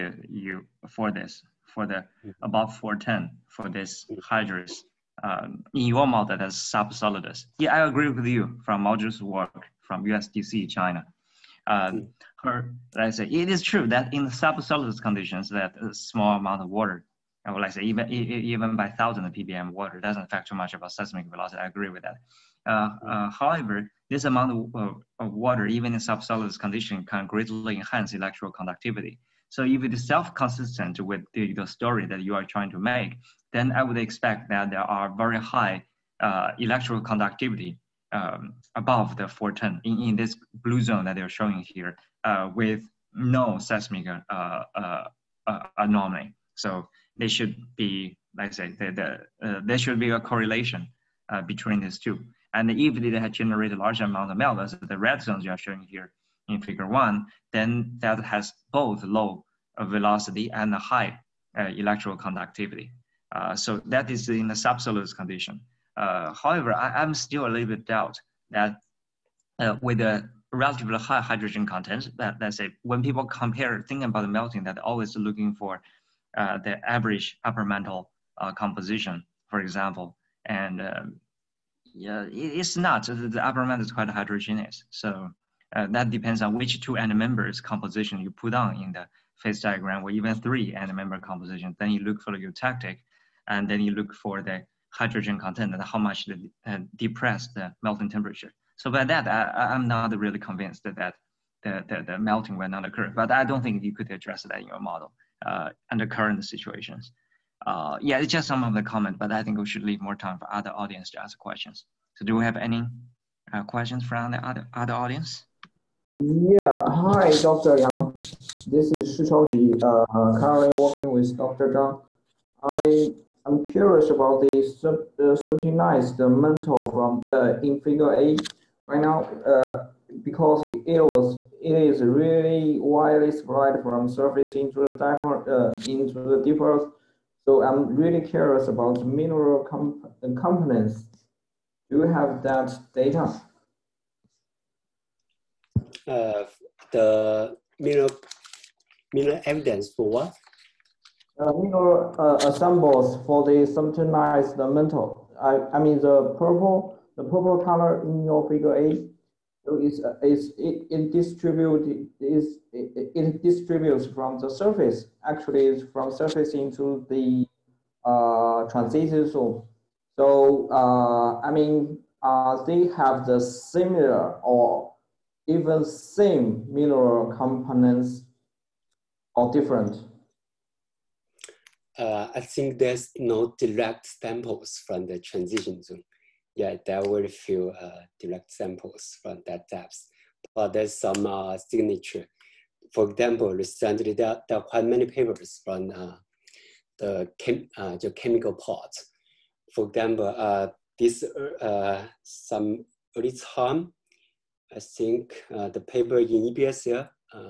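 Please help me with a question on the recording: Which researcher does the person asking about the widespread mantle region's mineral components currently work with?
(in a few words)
Dr. Zhang.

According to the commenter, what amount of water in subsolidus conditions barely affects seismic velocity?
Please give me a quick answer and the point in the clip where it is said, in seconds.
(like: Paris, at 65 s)
1000 ppm, at 18 s.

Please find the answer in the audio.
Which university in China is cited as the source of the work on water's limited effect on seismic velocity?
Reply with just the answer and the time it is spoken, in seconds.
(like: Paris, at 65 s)
USTC, at 10 s.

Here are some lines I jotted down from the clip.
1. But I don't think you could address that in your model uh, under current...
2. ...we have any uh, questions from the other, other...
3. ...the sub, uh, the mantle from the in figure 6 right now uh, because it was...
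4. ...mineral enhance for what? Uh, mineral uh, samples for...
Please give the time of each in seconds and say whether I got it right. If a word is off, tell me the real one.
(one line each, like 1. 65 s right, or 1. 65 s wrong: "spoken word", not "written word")
1. 103 s right
2. 112 s right
3. 124 s wrong: "8", not "6"
4. 149 s wrong: "evidence", not "enhance".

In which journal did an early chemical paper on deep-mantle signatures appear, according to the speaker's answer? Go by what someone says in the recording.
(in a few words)
EPSL.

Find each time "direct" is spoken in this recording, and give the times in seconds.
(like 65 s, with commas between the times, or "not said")
183 s, 188 s.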